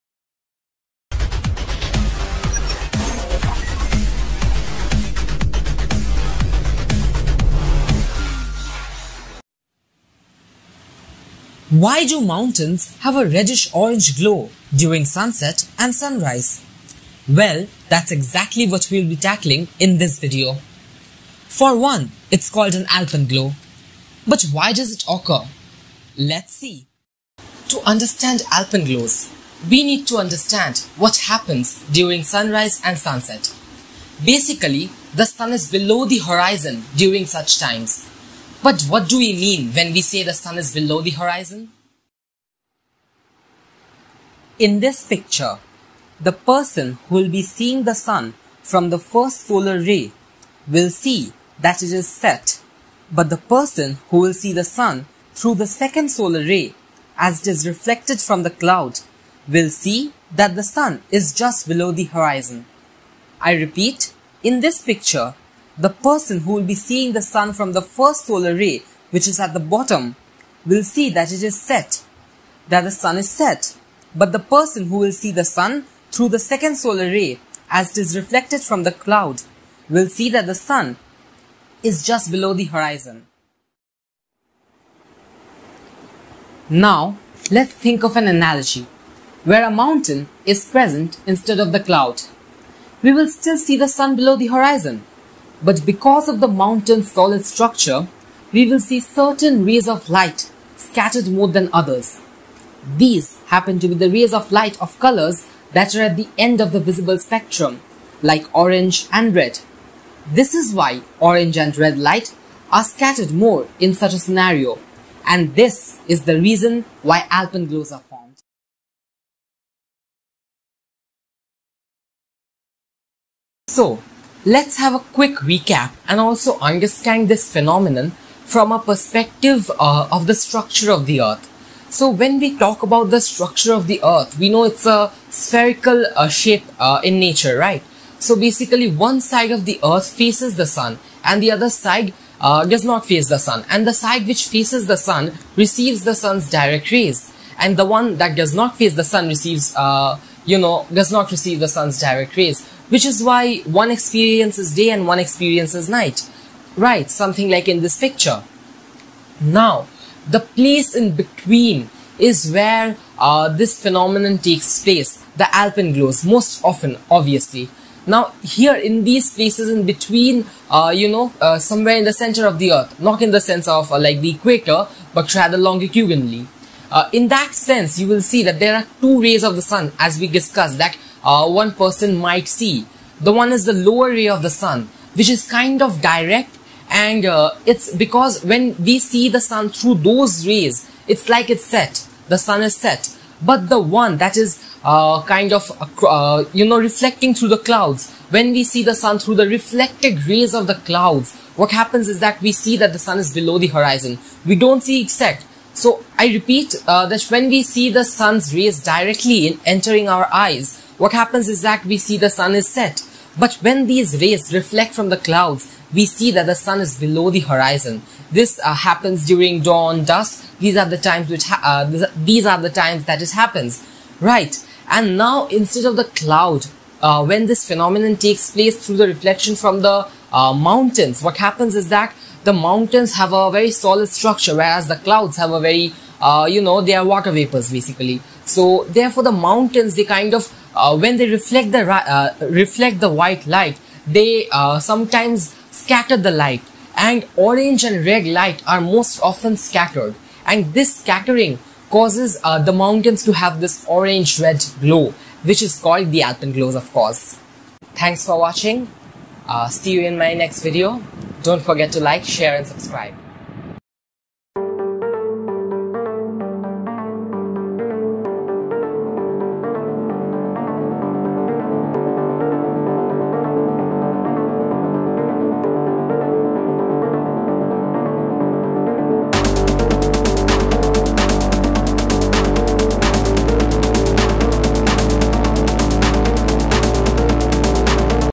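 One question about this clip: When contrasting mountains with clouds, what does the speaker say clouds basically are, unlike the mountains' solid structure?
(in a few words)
water vapors.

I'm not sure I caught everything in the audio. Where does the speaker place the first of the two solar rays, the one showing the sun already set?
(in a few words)
at the bottom.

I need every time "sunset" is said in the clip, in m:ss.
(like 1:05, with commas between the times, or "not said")
0:15, 0:32.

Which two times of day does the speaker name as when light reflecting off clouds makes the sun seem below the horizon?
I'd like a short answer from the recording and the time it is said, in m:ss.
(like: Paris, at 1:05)
dawn, dusk, at 3:39.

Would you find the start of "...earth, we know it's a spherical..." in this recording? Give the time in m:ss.
2:14.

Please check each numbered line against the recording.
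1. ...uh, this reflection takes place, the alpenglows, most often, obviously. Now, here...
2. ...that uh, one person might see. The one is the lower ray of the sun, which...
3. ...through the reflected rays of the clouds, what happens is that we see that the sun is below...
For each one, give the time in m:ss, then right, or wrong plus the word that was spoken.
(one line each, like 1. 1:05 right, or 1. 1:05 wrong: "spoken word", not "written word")
1. 2:43 wrong: "phenomenon", not "reflection"
2. 3:00 right
3. 3:19 right.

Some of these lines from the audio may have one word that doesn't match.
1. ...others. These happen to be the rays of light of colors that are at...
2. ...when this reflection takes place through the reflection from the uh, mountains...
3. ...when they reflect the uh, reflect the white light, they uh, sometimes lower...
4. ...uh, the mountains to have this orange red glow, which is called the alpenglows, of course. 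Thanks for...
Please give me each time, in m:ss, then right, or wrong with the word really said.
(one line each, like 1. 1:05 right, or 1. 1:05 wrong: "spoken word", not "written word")
1. 1:41 right
2. 3:47 wrong: "phenomenon", not "reflection"
3. 4:00 wrong: "scatter", not "lower"
4. 4:12 right.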